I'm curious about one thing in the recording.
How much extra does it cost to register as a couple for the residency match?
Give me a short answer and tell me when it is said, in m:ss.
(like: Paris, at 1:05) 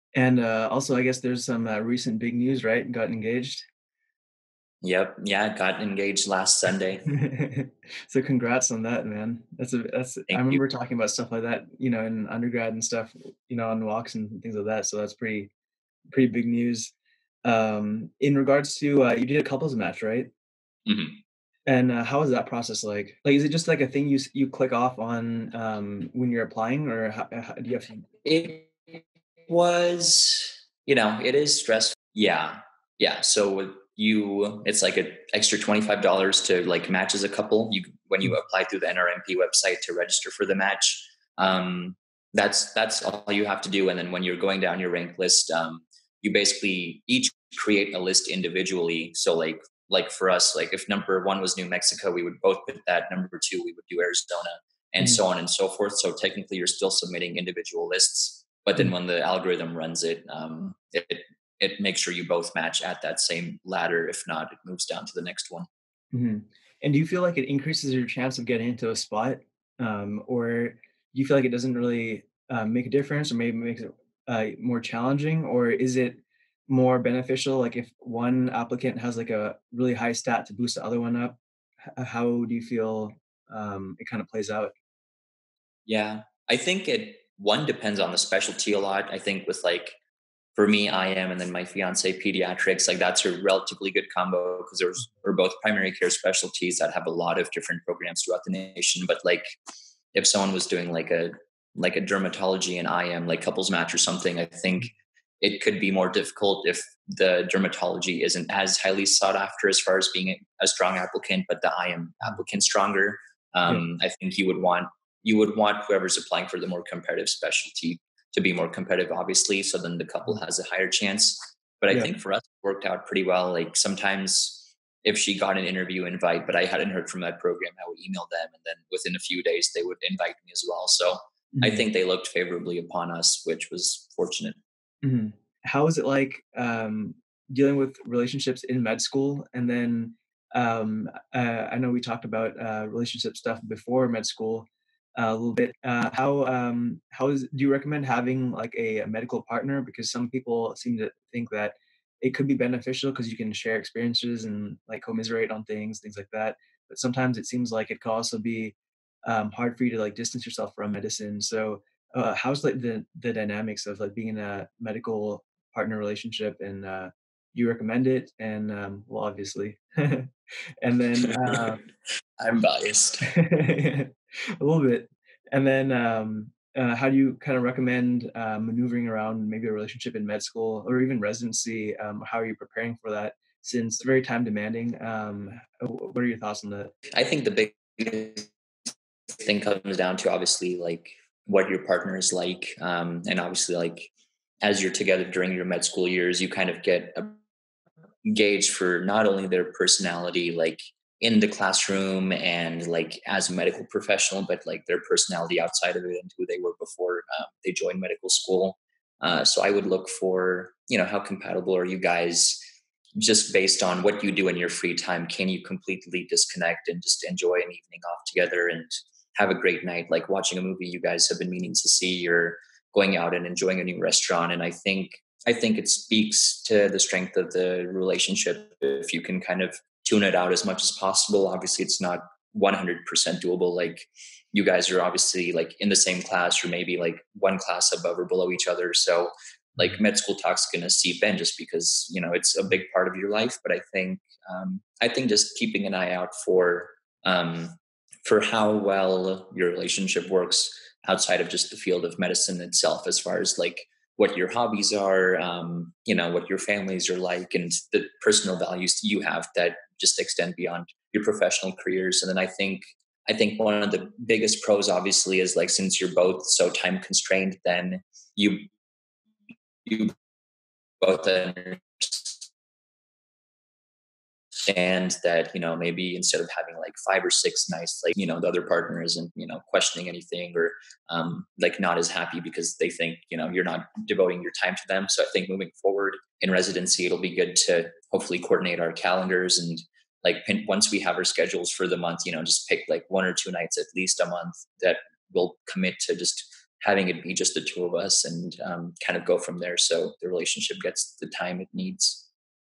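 $25, at 0:35.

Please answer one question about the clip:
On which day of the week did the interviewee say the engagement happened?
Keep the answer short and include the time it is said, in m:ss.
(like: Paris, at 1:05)
Sunday, at 0:06.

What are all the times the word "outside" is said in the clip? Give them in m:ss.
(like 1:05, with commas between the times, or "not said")
3:25, 4:11.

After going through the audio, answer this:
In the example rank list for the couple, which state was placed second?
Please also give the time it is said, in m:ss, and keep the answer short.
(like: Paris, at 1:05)
Arizona, at 0:53.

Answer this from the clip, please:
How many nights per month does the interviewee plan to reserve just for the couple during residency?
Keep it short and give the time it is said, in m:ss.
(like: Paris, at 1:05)
1 or 2, at 4:53.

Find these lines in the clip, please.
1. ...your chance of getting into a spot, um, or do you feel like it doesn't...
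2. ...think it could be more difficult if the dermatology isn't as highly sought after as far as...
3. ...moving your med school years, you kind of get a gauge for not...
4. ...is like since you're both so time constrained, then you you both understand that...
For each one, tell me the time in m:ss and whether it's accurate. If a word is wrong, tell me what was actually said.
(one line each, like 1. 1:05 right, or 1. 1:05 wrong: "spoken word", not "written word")
1. 1:07 right
2. 1:44 right
3. 3:15 wrong: "during", not "moving"
4. 4:25 right.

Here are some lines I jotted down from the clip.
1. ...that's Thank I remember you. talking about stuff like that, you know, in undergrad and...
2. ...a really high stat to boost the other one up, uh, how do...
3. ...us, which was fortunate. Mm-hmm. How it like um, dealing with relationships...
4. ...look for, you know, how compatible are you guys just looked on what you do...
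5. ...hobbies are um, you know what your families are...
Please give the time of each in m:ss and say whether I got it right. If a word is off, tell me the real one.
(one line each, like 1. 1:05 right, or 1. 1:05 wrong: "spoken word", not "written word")
1. 0:09 right
2. 1:19 right
3. 2:13 right
4. 3:29 wrong: "based", not "looked"
5. 4:14 right.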